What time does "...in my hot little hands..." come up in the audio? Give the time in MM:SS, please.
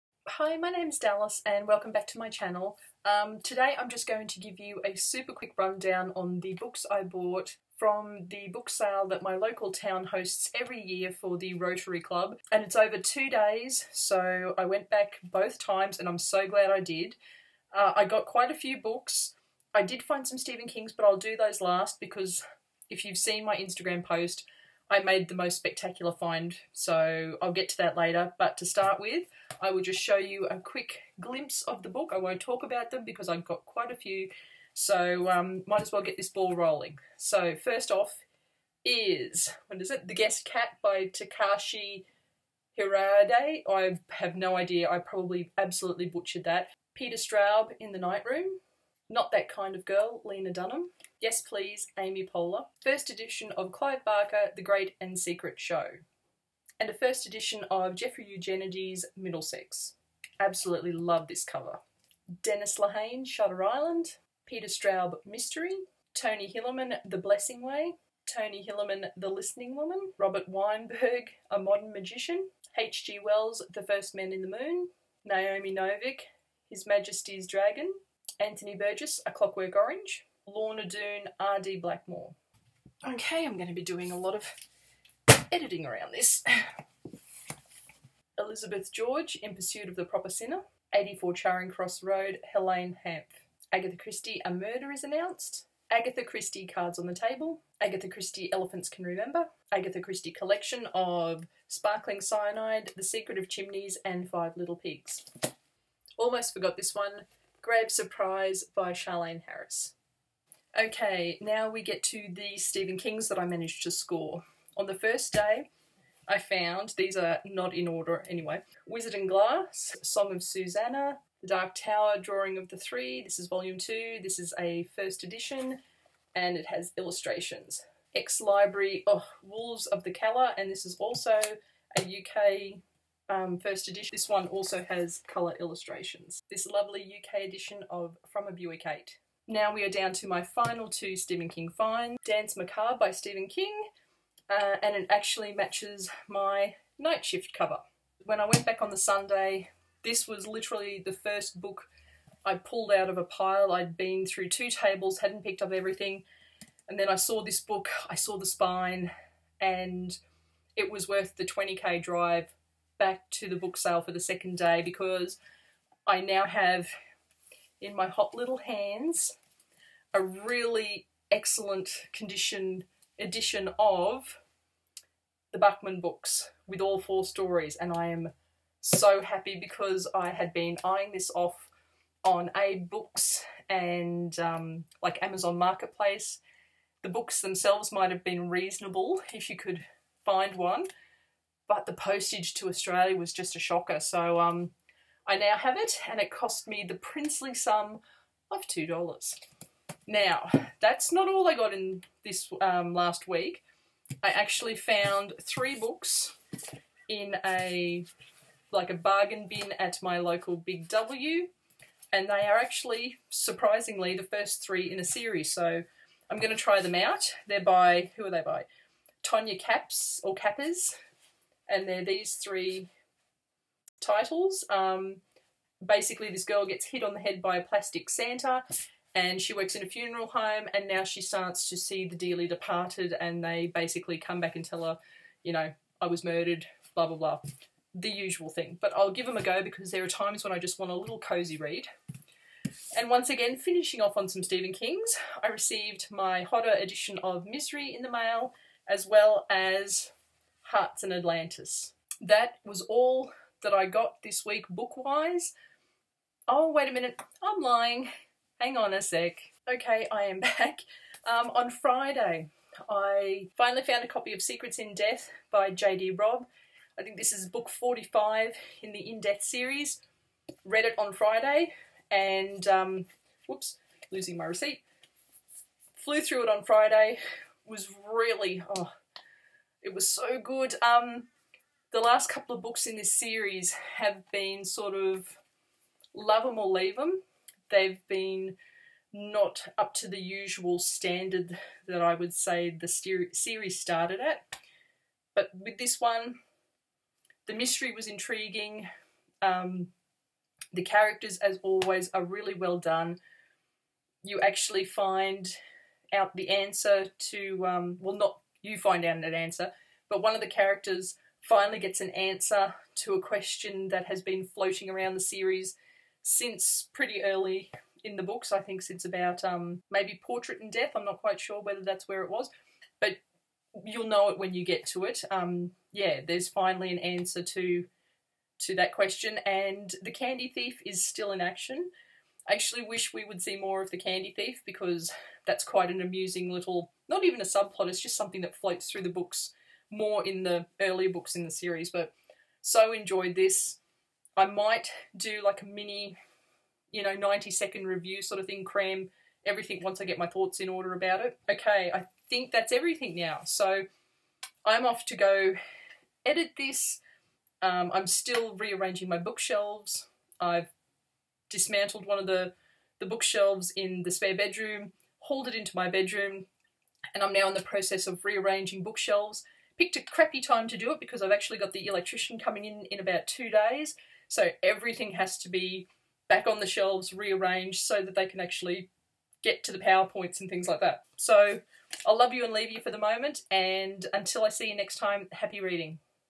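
02:47.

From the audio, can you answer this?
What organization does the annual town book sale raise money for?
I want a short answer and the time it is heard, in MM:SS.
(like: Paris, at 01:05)
Rotary Club, at 00:11.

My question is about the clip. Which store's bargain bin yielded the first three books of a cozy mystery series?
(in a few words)
Big W.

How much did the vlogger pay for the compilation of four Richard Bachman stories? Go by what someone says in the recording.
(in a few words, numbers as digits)
2 dollars.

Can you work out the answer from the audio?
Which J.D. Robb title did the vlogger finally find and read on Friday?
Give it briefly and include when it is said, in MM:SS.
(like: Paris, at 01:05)
Secrets in Death, at 04:24.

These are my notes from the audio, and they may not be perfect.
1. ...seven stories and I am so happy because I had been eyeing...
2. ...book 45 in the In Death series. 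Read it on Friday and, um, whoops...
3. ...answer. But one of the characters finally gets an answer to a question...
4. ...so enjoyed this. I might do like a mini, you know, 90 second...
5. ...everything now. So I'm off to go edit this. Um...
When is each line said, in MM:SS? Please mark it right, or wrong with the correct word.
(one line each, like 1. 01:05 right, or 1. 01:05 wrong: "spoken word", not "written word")
1. 02:56 wrong: "four", not "seven"
2. 04:27 right
3. 05:09 right
4. 05:42 right
5. 05:52 right.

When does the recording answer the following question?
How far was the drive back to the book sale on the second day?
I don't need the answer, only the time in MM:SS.
02:41.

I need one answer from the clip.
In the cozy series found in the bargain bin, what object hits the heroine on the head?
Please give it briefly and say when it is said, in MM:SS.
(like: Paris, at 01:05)
a plastic Santa, at 03:47.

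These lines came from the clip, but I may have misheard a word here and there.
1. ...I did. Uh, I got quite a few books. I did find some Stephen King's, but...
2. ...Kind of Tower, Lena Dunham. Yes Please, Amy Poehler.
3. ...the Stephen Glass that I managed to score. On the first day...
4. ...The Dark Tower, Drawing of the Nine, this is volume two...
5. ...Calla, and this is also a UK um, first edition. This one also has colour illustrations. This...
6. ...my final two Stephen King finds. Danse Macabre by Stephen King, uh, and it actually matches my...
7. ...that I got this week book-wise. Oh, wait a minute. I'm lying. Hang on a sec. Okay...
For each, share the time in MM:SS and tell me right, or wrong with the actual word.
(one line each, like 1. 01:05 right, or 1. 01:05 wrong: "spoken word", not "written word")
1. 00:16 right
2. 00:49 wrong: "Girl", not "Tower"
3. 01:52 wrong: "Kings", not "Glass"
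4. 02:01 wrong: "Three", not "Nine"
5. 02:10 right
6. 02:20 right
7. 04:13 right.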